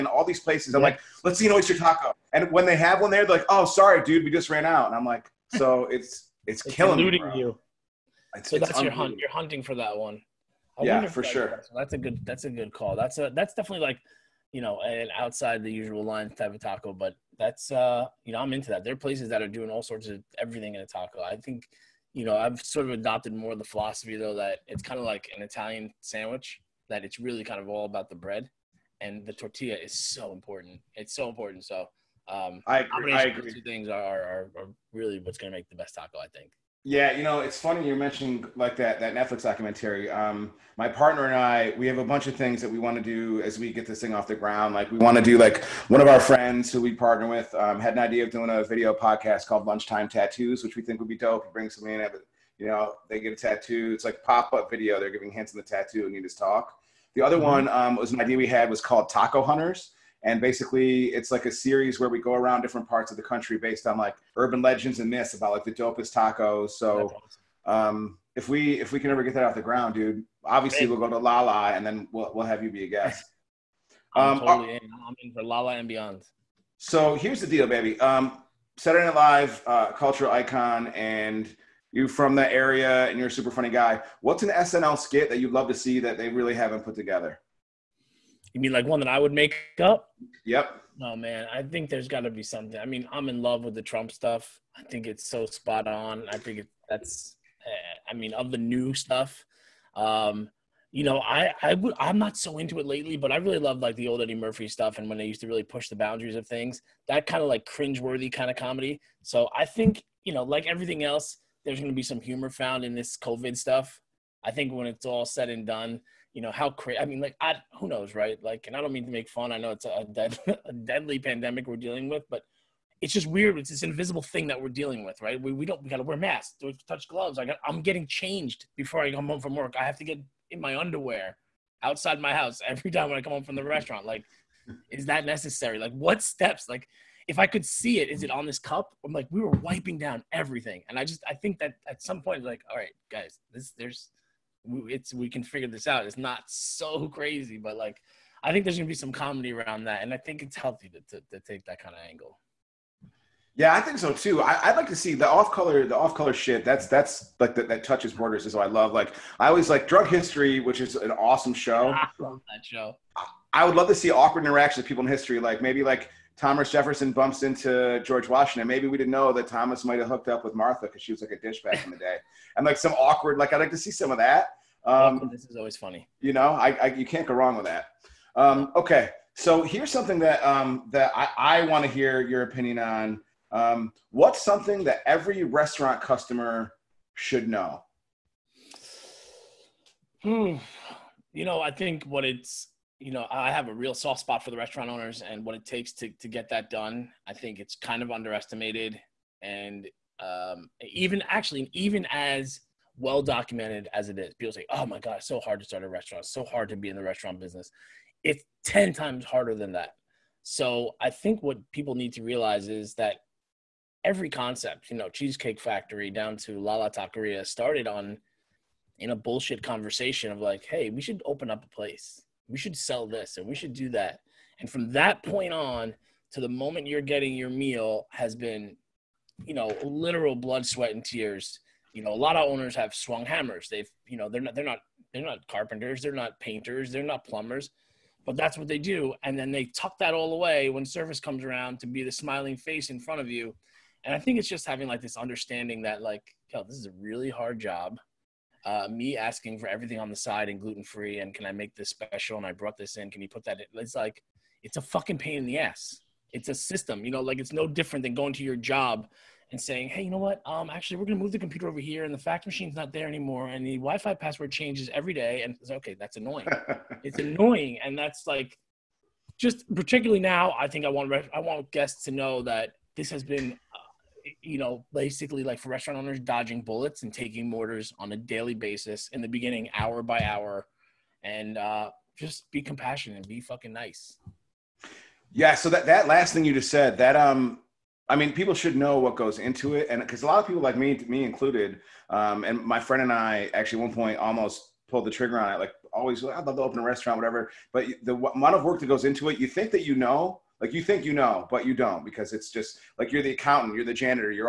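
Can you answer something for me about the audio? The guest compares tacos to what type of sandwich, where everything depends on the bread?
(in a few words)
Italian sandwich.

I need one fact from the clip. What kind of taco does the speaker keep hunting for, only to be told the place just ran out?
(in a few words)
Oyster taco.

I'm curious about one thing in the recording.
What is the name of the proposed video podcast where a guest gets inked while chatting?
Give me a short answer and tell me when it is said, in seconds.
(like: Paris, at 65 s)
Lunchtime Tattoos, at 49 s.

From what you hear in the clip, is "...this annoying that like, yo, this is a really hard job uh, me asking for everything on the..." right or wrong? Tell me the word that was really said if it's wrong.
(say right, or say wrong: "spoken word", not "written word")
wrong: "understanding", not "annoying".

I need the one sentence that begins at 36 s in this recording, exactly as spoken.
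Yeah, you know, it's funny you mentioned like that that Netflix documentary.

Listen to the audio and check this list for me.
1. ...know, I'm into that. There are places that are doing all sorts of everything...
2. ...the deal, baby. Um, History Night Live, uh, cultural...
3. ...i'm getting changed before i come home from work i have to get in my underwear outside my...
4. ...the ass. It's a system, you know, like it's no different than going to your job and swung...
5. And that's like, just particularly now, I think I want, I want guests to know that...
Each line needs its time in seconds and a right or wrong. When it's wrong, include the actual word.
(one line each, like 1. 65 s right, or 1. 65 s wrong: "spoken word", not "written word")
1. 18 s right
2. 77 s wrong: "Saturday", not "History"
3. 127 s right
4. 255 s wrong: "saying", not "swung"
5. 267 s right.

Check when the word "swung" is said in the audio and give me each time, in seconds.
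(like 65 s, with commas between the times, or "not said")
232 s.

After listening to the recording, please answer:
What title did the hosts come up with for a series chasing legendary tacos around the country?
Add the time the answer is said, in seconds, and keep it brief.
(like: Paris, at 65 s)
Taco Hunters, at 59 s.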